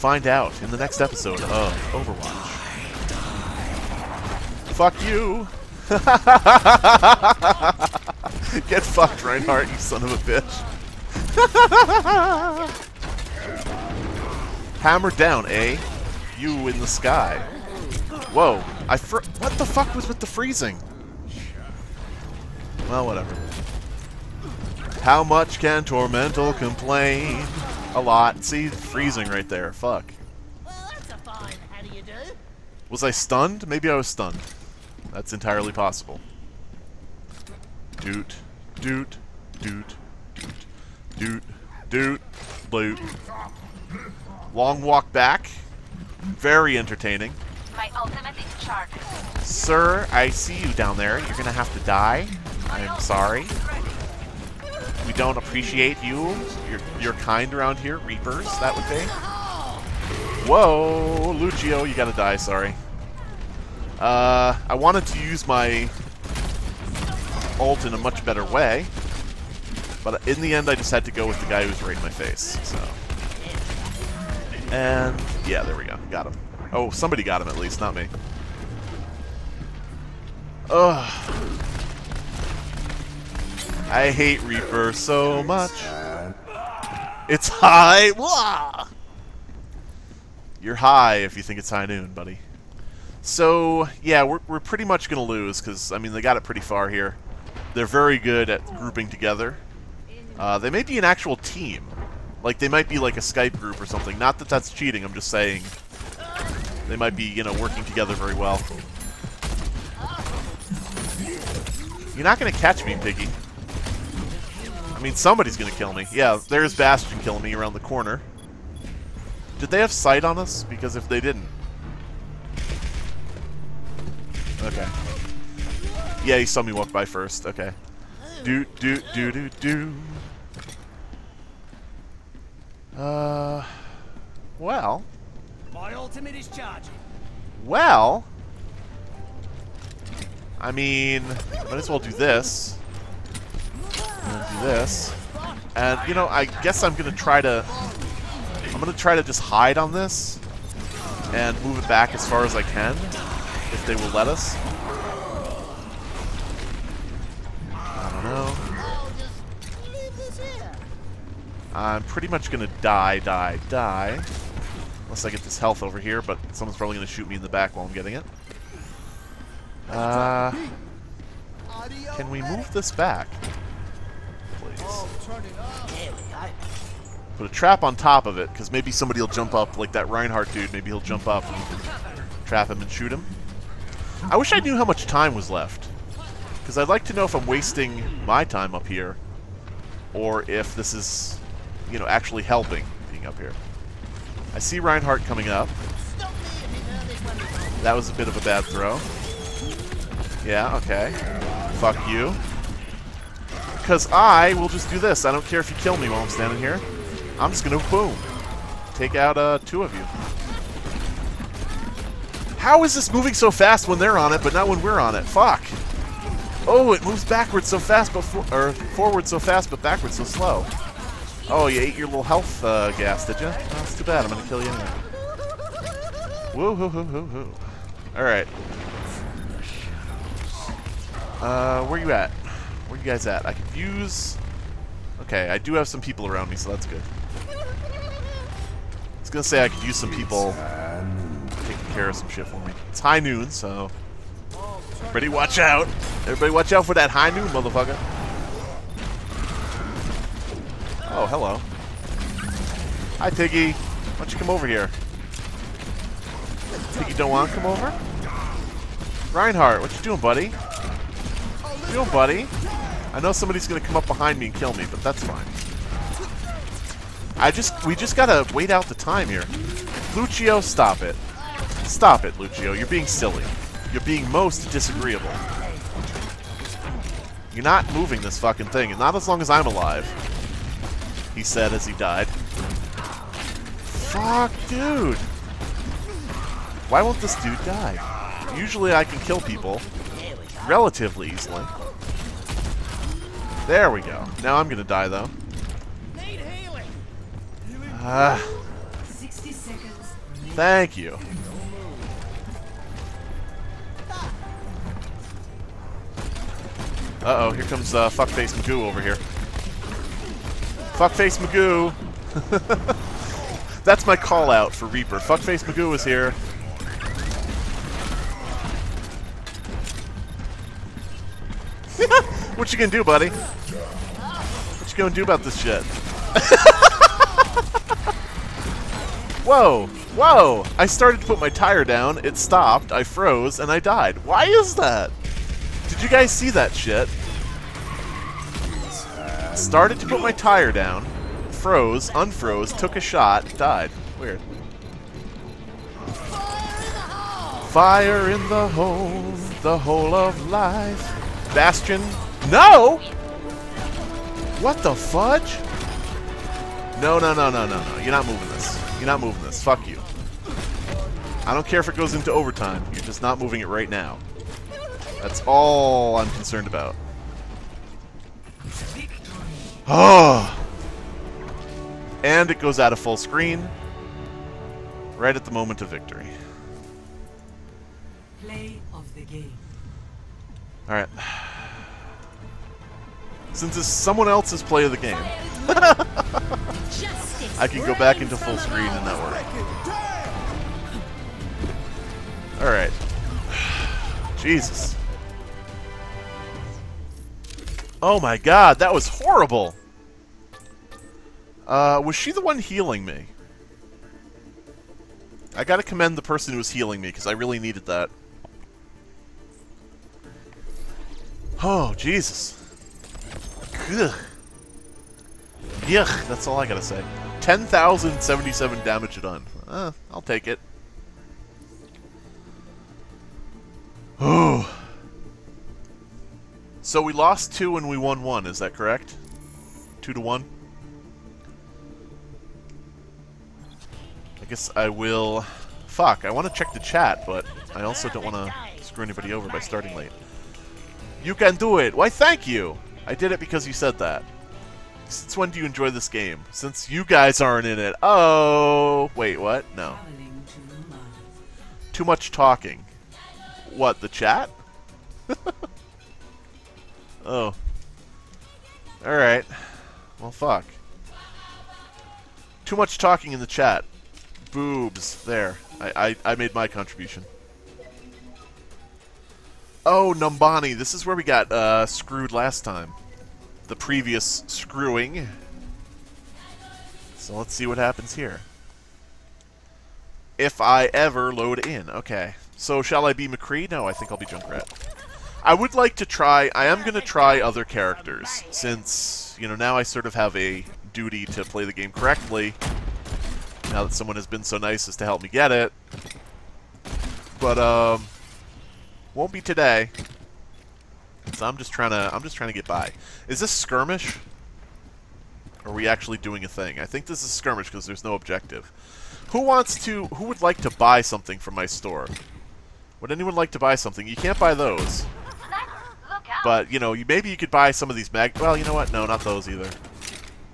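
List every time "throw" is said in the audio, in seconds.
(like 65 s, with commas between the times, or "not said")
198 s.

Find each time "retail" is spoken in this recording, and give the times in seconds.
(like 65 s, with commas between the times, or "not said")
not said.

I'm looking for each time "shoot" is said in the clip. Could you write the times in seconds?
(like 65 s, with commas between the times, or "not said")
167 s, 182 s.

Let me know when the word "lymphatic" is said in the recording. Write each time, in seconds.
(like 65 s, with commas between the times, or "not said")
not said.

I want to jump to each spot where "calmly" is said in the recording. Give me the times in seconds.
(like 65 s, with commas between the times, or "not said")
not said.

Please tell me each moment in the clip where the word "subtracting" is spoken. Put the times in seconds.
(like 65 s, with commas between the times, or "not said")
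not said.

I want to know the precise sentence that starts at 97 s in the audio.
They're very good at grouping together.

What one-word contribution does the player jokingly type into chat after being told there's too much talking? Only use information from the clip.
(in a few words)
Boobs.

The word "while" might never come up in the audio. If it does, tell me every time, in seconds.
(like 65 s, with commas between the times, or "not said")
167 s, 206 s.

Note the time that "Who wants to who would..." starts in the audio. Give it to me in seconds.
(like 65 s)
509 s.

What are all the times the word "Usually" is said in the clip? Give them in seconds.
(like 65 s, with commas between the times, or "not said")
288 s.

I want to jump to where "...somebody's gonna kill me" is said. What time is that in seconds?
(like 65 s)
115 s.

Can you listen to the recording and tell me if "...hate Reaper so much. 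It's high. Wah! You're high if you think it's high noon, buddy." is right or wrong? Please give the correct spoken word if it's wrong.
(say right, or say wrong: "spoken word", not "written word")
right.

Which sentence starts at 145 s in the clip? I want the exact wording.
And, you know, I guess I'm gonna try to...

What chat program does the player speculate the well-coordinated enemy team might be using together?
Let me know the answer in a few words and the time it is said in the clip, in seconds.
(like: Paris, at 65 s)
Skype, at 103 s.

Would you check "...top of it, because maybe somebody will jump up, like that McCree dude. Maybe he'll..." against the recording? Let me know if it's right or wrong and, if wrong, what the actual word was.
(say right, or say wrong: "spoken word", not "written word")
wrong: "Reinhardt", not "McCree".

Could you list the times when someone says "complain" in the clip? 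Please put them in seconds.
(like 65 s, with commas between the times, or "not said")
26 s.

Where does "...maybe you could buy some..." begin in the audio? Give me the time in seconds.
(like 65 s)
517 s.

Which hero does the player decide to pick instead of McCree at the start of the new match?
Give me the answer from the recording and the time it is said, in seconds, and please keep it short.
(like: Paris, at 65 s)
Junkrat, at 484 s.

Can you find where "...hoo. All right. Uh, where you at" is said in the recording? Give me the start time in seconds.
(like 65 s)
227 s.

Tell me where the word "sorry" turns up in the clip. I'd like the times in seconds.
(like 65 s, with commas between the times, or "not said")
53 s, 62 s.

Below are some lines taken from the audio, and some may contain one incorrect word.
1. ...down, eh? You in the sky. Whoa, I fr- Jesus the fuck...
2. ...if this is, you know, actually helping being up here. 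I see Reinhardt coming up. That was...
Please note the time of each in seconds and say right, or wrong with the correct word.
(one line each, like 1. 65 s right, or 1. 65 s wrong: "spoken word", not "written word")
1. 15 s wrong: "What", not "Jesus"
2. 190 s right.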